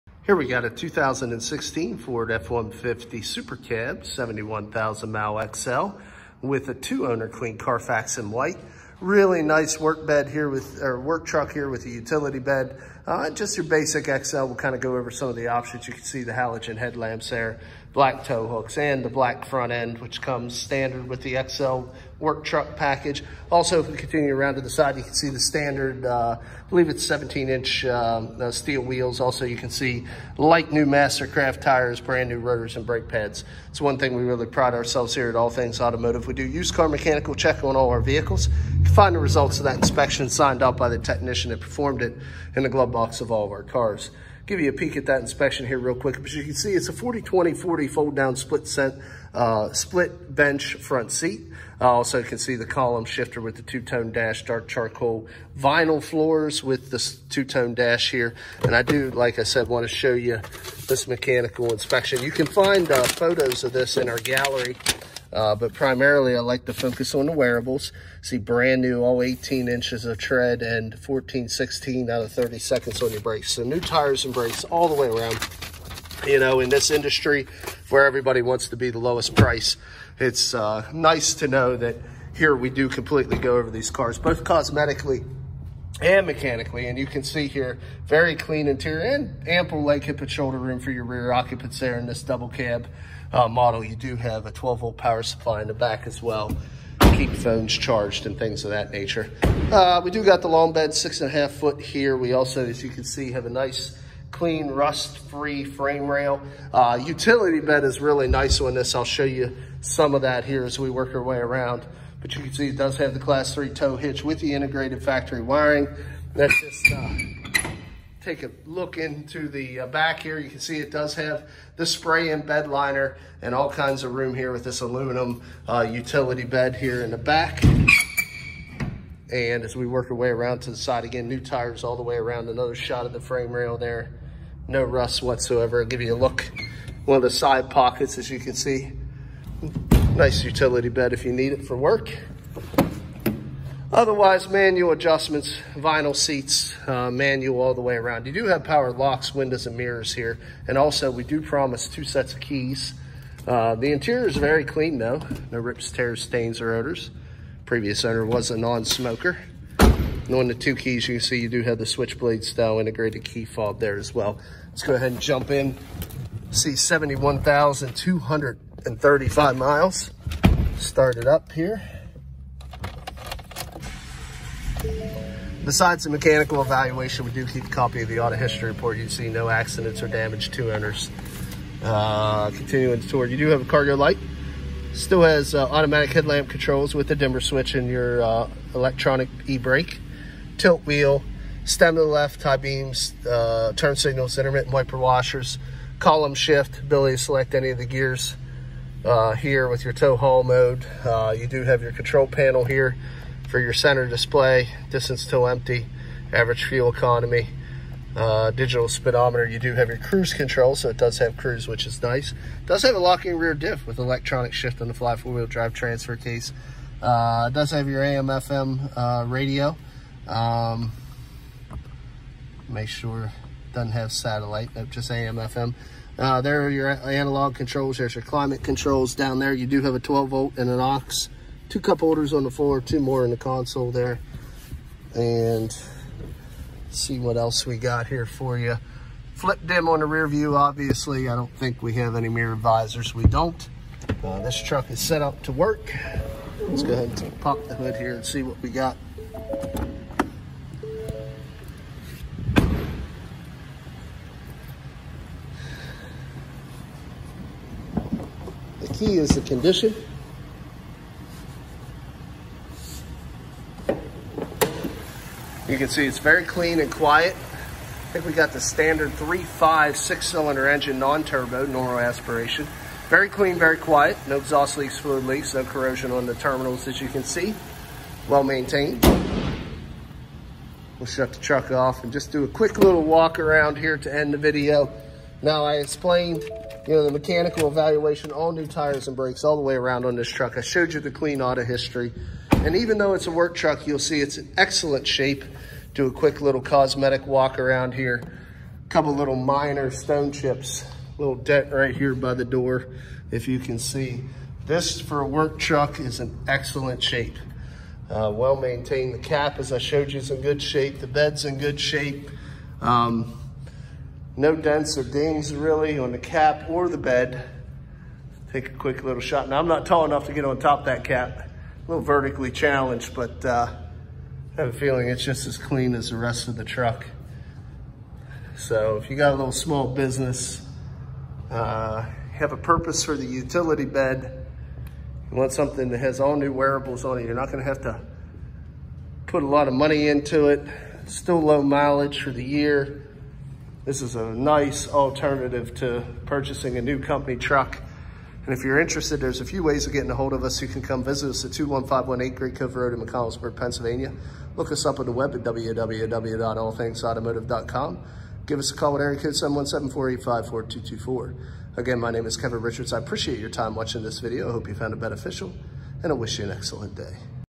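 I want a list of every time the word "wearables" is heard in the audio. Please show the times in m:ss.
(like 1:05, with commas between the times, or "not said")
1:07, 5:36.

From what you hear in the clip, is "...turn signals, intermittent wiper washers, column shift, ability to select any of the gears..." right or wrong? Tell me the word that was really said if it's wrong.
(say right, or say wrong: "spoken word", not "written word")
right.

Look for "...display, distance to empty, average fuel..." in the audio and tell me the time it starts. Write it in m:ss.
3:24.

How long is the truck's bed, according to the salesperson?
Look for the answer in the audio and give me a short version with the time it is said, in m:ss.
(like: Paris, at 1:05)
6.5 feet, at 1:40.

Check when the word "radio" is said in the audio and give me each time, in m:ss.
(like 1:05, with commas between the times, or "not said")
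3:39.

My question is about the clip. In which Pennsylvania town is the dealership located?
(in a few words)
McConnellsburg.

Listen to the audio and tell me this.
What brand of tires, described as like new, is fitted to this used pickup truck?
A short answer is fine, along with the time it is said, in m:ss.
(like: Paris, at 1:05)
Mastercraft, at 0:30.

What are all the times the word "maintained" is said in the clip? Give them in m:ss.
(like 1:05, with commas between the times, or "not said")
4:38, 5:08.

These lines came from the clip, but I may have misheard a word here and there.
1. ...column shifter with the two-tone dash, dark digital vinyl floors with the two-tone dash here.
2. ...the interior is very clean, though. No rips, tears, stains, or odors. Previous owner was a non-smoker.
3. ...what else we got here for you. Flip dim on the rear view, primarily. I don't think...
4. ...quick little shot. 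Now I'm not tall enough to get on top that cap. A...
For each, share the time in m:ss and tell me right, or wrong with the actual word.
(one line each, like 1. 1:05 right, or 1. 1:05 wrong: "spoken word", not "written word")
1. 0:52 wrong: "charcoal", not "digital"
2. 2:33 right
3. 3:57 wrong: "obviously", not "primarily"
4. 5:18 right.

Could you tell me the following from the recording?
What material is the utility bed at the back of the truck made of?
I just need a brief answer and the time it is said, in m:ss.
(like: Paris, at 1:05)
Aluminum, at 2:04.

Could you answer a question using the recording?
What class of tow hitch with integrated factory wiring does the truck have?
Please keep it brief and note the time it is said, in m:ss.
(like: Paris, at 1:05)
Class 3, at 1:53.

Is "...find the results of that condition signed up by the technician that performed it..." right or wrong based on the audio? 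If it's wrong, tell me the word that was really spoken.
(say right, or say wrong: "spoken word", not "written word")
wrong: "inspection", not "condition".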